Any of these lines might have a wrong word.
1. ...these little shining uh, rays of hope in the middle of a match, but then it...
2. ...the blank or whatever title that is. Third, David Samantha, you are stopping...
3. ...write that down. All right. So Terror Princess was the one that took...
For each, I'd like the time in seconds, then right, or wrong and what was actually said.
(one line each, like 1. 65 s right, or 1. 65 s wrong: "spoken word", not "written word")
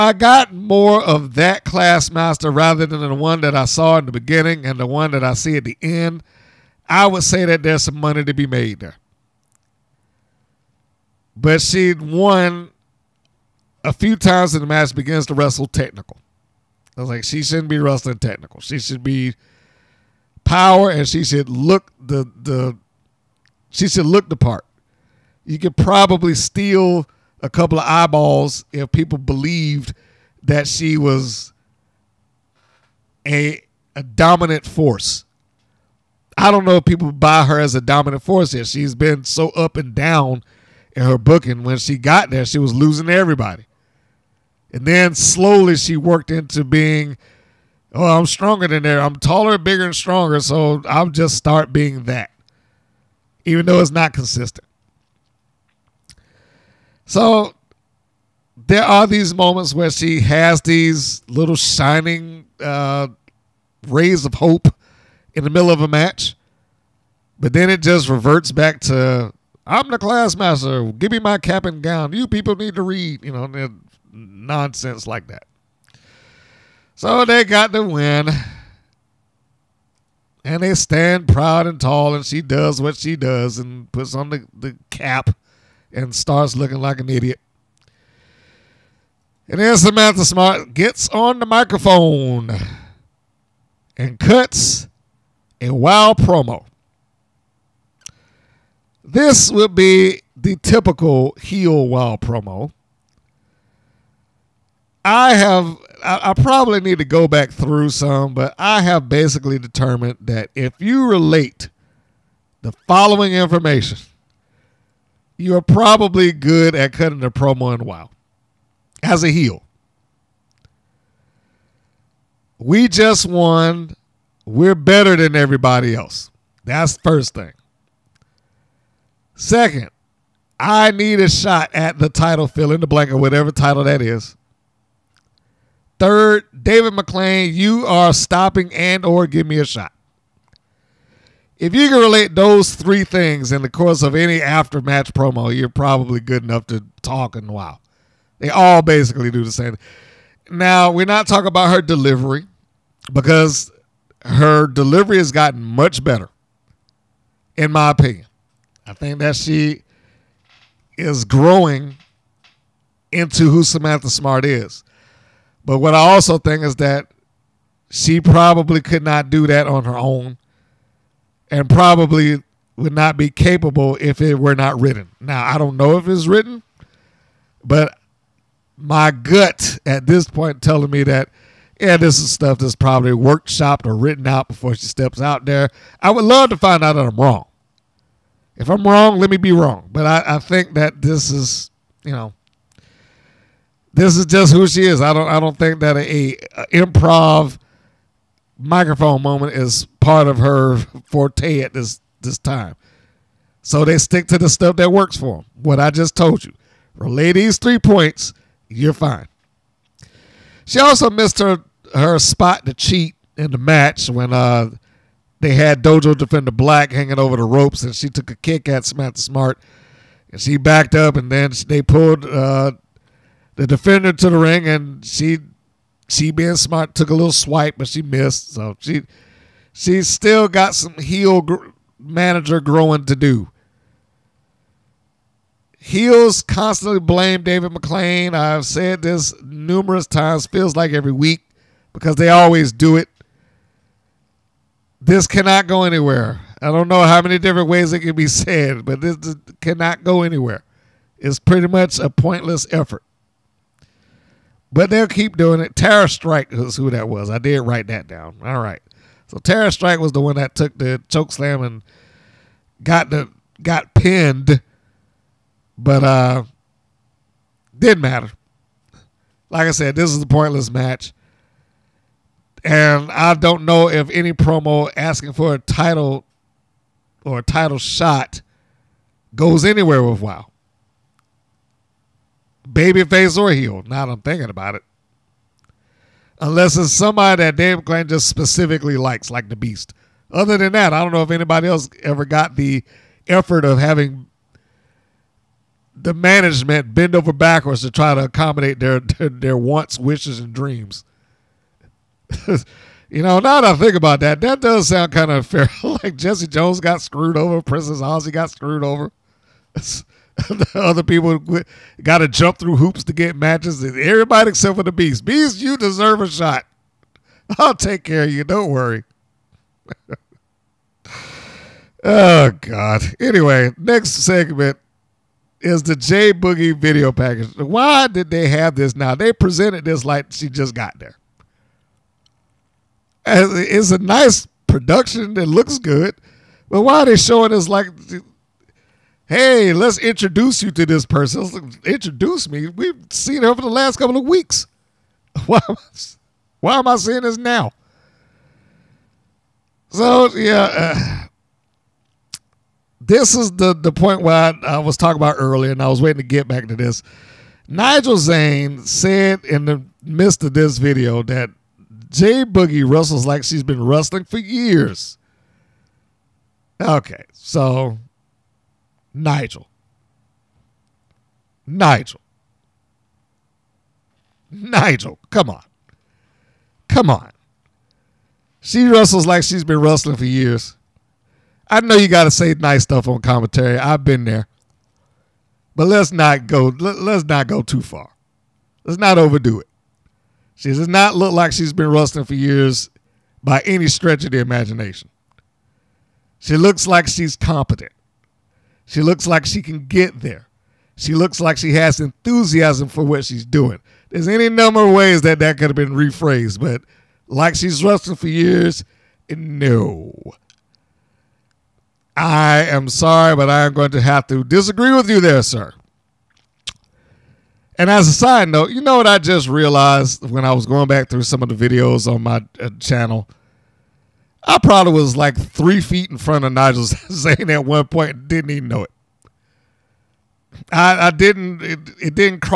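1. 60 s right
2. 132 s wrong: "McLane", not "Samantha"
3. 257 s wrong: "Strike", not "Princess".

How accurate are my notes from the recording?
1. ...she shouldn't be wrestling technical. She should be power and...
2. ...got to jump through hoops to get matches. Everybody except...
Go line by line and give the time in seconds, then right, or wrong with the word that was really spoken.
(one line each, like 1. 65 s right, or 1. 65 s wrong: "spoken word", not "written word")
1. 17 s right
2. 312 s right.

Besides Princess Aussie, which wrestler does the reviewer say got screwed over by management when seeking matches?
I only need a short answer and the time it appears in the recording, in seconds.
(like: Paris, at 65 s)
Jesse Jones, at 306 s.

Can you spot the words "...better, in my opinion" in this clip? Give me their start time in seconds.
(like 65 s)
156 s.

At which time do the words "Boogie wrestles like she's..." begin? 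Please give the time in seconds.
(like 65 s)
362 s.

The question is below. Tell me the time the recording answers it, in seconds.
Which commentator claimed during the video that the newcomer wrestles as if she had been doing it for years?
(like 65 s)
357 s.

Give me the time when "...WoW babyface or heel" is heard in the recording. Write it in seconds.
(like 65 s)
280 s.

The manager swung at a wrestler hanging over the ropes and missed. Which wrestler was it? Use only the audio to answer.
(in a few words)
Dojo Defender Black.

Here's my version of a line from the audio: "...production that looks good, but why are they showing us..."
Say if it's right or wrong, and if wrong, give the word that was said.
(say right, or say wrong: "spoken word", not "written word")
right.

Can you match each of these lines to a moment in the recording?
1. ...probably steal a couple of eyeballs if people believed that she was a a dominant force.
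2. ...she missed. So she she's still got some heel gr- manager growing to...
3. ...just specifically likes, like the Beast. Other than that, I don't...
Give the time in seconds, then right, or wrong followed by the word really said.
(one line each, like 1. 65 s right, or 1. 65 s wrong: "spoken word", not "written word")
1. 25 s right
2. 227 s right
3. 288 s right.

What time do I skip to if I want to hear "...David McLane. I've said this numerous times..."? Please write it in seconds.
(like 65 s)
237 s.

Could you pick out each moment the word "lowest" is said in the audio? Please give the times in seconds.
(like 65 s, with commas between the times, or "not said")
not said.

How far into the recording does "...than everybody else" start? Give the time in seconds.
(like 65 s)
125 s.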